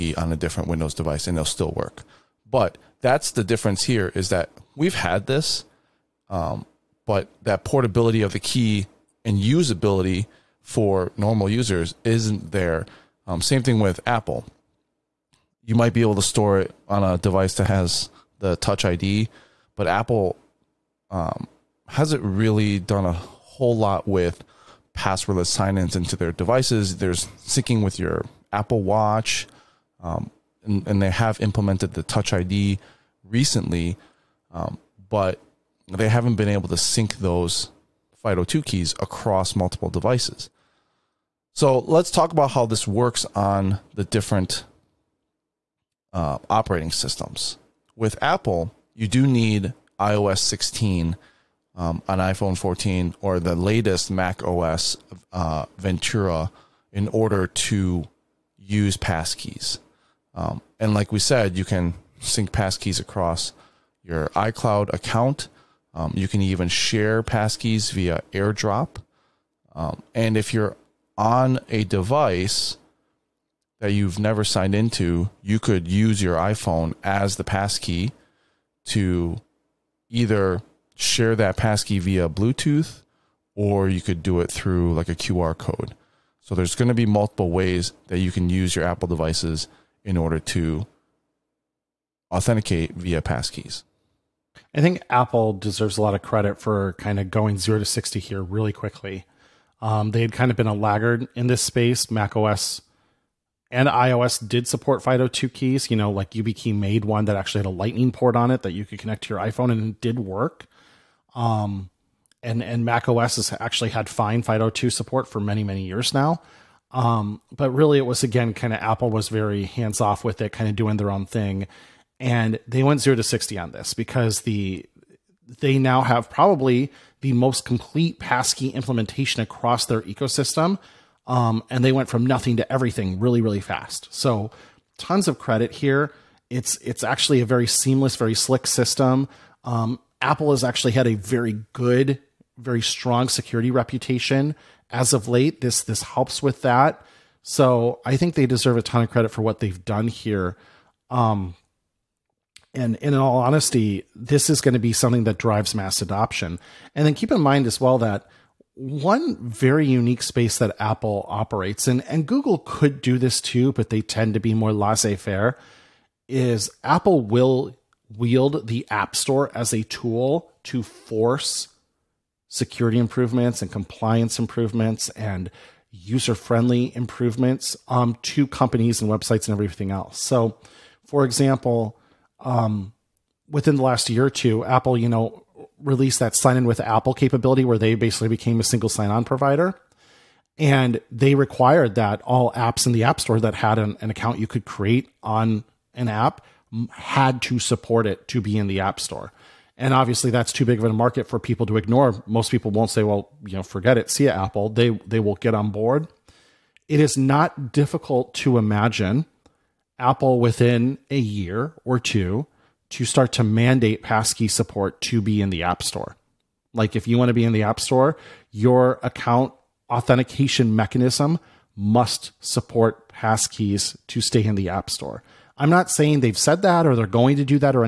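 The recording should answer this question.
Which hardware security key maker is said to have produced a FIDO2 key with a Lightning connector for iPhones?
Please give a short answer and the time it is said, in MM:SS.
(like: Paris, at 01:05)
YubiKey, at 01:46.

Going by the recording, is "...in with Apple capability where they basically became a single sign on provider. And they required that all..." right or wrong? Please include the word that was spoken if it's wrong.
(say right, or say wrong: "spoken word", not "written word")
right.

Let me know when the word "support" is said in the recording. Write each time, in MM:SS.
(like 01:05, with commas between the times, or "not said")
01:44, 01:54, 03:17, 03:34, 03:42.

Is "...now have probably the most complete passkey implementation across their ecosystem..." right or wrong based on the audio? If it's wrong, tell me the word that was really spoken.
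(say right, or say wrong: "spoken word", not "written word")
right.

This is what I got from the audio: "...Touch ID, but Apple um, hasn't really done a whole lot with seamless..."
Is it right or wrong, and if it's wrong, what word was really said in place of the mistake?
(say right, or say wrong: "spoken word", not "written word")
wrong: "passwordless", not "seamless".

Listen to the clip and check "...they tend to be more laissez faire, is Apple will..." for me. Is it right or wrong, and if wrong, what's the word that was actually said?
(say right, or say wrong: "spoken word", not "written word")
right.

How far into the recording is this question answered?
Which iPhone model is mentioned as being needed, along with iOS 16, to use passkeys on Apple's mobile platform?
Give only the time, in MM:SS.
00:52.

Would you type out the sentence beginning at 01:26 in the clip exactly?
So there's going to be multiple ways that you can use your Apple devices in order to authenticate via passkeys.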